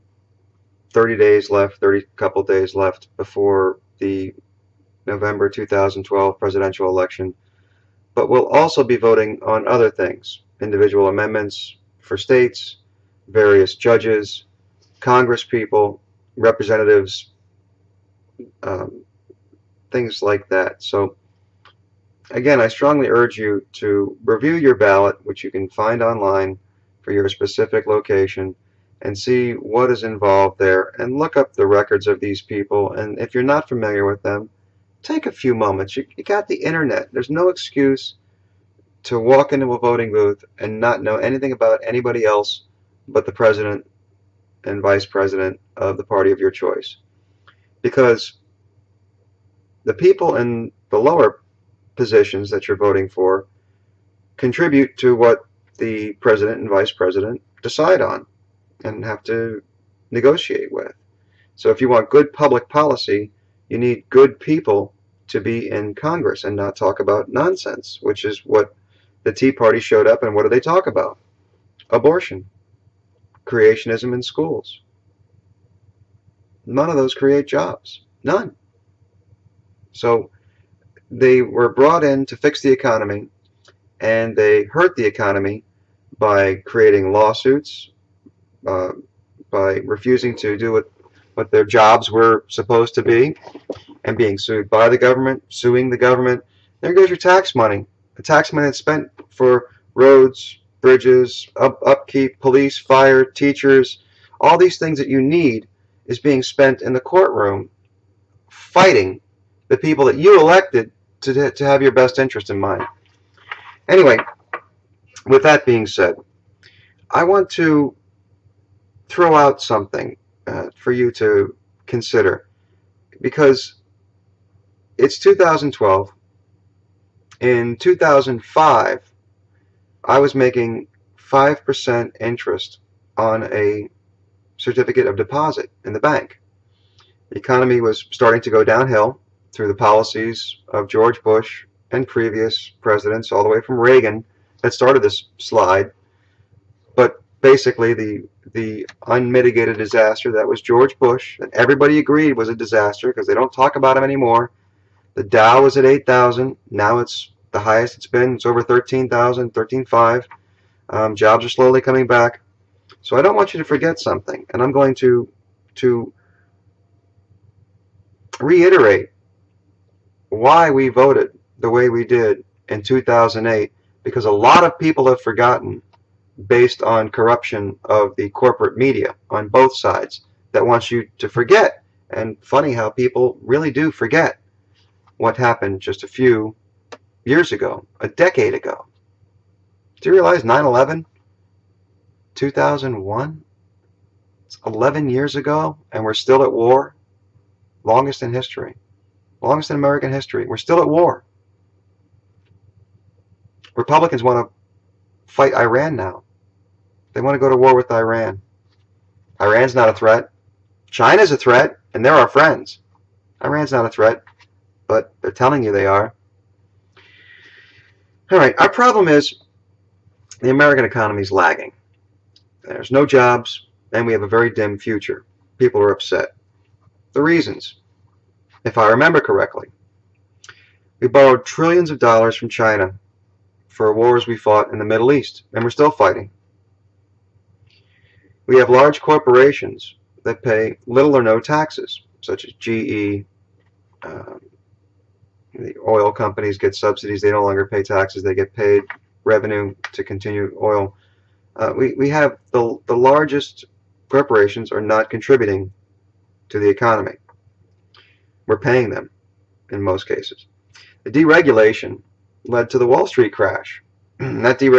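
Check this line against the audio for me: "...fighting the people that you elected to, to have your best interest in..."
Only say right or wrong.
right.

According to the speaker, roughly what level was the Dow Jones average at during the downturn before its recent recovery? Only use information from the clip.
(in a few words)
8,000.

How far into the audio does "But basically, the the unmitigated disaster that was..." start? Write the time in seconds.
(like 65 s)
146 s.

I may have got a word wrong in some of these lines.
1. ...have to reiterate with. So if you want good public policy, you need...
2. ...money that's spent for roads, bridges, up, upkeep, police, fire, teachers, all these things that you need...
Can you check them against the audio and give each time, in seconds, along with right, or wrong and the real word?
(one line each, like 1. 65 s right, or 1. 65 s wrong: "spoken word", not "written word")
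1. 59 s wrong: "negotiate", not "reiterate"
2. 98 s right.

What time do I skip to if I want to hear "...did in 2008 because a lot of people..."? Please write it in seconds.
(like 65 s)
172 s.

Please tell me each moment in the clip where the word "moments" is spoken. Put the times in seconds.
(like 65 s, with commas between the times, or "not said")
35 s.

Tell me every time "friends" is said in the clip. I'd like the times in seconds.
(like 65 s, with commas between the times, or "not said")
212 s.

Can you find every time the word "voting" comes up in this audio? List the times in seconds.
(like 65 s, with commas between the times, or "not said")
8 s, 39 s, 52 s.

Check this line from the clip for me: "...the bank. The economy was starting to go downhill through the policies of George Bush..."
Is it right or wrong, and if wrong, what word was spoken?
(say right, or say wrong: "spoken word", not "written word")
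right.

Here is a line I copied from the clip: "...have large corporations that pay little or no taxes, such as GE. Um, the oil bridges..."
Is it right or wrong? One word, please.
wrong.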